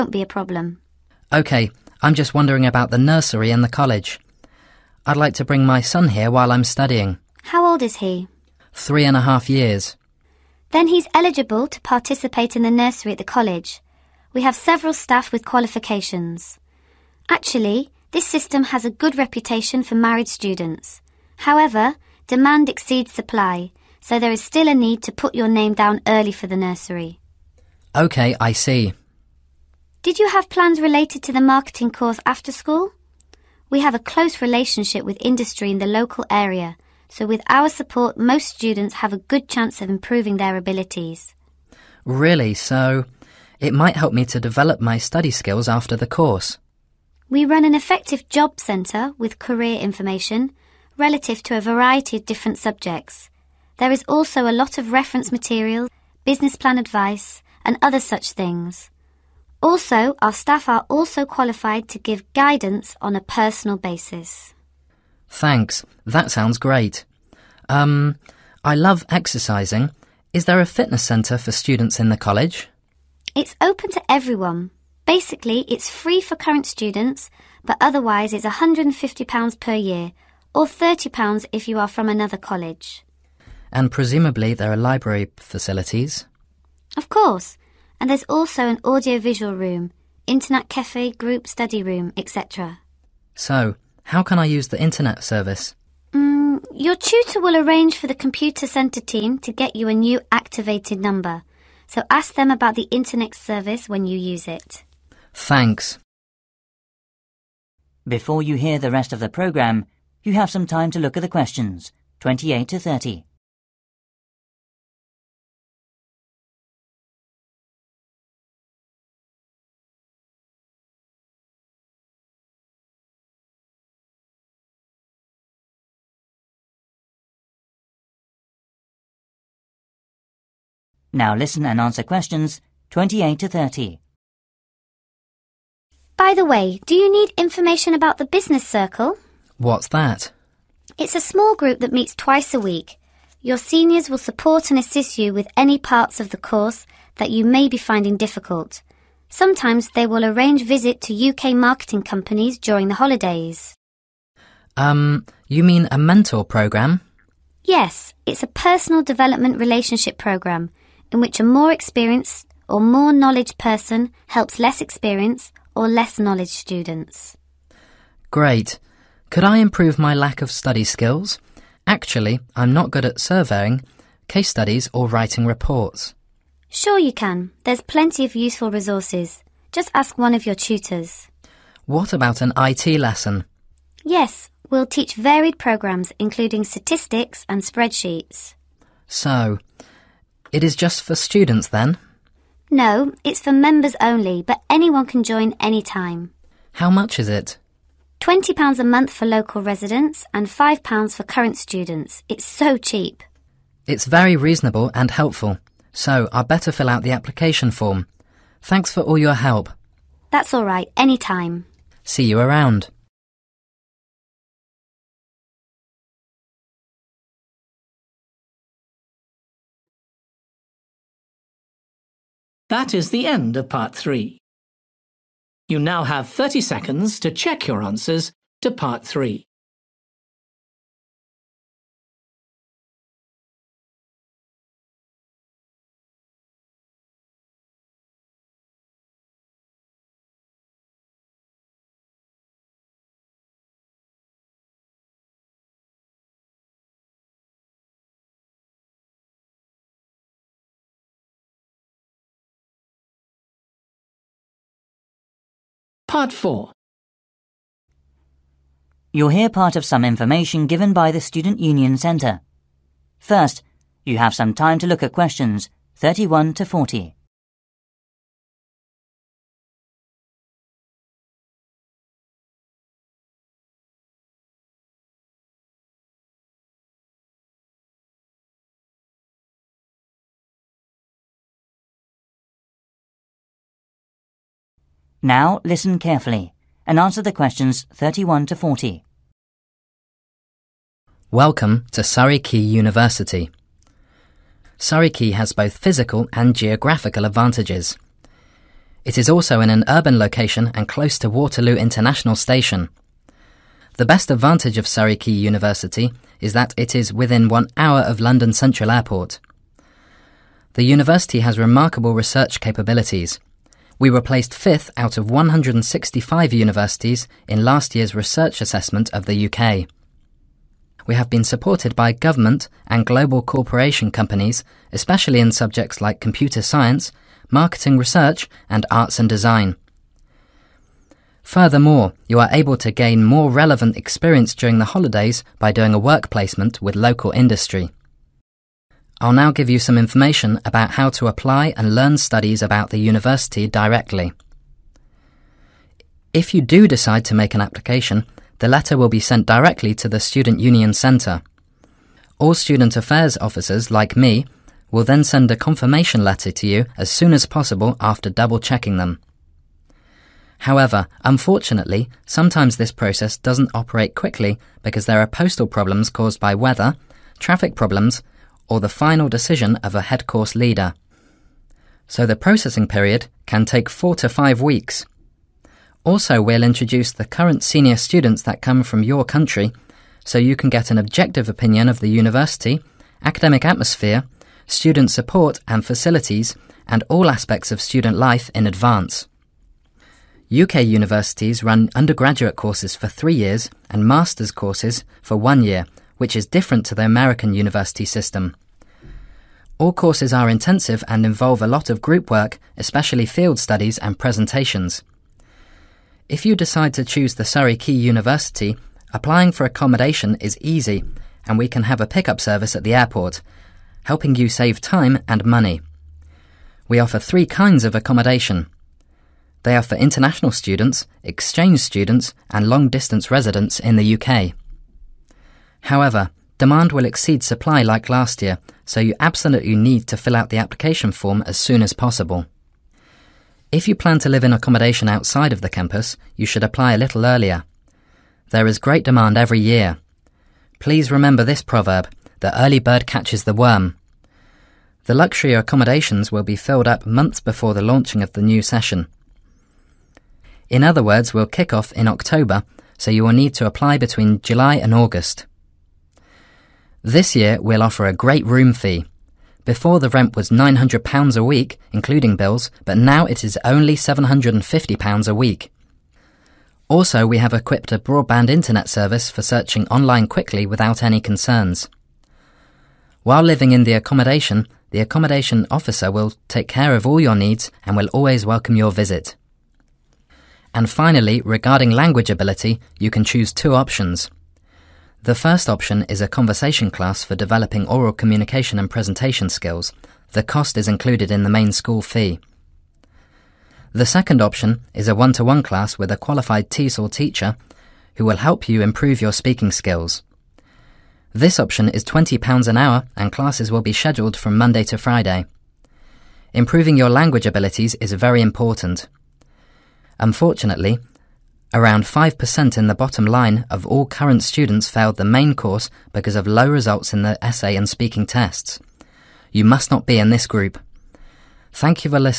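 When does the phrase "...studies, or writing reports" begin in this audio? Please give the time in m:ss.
2:54.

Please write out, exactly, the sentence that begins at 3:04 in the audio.
Yes, we'll teach varied programs, including statistics and spreadsheets.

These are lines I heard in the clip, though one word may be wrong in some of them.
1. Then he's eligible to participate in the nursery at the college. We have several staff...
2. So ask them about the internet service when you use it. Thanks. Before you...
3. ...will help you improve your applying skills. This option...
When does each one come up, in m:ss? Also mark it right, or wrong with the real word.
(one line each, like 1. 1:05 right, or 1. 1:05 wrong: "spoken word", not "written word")
1. 0:10 right
2. 1:41 right
3. 8:18 wrong: "speaking", not "applying".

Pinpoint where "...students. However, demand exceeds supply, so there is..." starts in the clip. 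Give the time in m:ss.
0:20.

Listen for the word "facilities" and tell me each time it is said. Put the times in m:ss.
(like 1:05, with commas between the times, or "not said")
1:25, 6:25.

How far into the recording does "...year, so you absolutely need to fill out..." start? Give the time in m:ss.
7:08.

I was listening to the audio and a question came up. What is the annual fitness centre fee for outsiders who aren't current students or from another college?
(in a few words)
£150.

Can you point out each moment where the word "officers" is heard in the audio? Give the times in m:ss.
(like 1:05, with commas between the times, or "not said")
5:53, 7:55.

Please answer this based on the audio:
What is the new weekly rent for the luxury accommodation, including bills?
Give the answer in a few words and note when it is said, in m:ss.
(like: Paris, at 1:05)
£750, at 7:43.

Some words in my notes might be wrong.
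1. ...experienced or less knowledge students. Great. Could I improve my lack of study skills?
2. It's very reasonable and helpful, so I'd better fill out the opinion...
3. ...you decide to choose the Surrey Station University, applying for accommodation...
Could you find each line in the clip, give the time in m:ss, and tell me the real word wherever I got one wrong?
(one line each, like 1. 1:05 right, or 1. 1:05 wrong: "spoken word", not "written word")
1. 2:44 right
2. 3:23 wrong: "application", not "opinion"
3. 6:46 wrong: "Quay", not "Station".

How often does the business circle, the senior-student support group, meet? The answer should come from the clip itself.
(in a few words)
twice a week.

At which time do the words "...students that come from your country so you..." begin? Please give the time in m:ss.
6:17.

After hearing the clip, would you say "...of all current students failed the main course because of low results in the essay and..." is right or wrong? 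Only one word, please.
right.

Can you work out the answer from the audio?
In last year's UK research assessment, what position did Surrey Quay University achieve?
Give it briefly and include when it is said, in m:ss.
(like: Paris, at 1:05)
fifth, at 5:14.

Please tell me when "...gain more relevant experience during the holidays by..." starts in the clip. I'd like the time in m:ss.
5:32.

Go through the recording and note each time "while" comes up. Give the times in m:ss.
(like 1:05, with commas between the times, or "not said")
0:06, 7:53.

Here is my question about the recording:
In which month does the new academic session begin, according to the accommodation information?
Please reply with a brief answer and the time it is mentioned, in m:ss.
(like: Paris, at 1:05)
October, at 7:32.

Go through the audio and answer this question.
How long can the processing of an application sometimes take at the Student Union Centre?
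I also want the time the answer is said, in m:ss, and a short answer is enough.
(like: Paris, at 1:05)
4 to 5 weeks, at 6:13.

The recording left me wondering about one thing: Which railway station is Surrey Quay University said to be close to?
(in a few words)
Waterloo International Station.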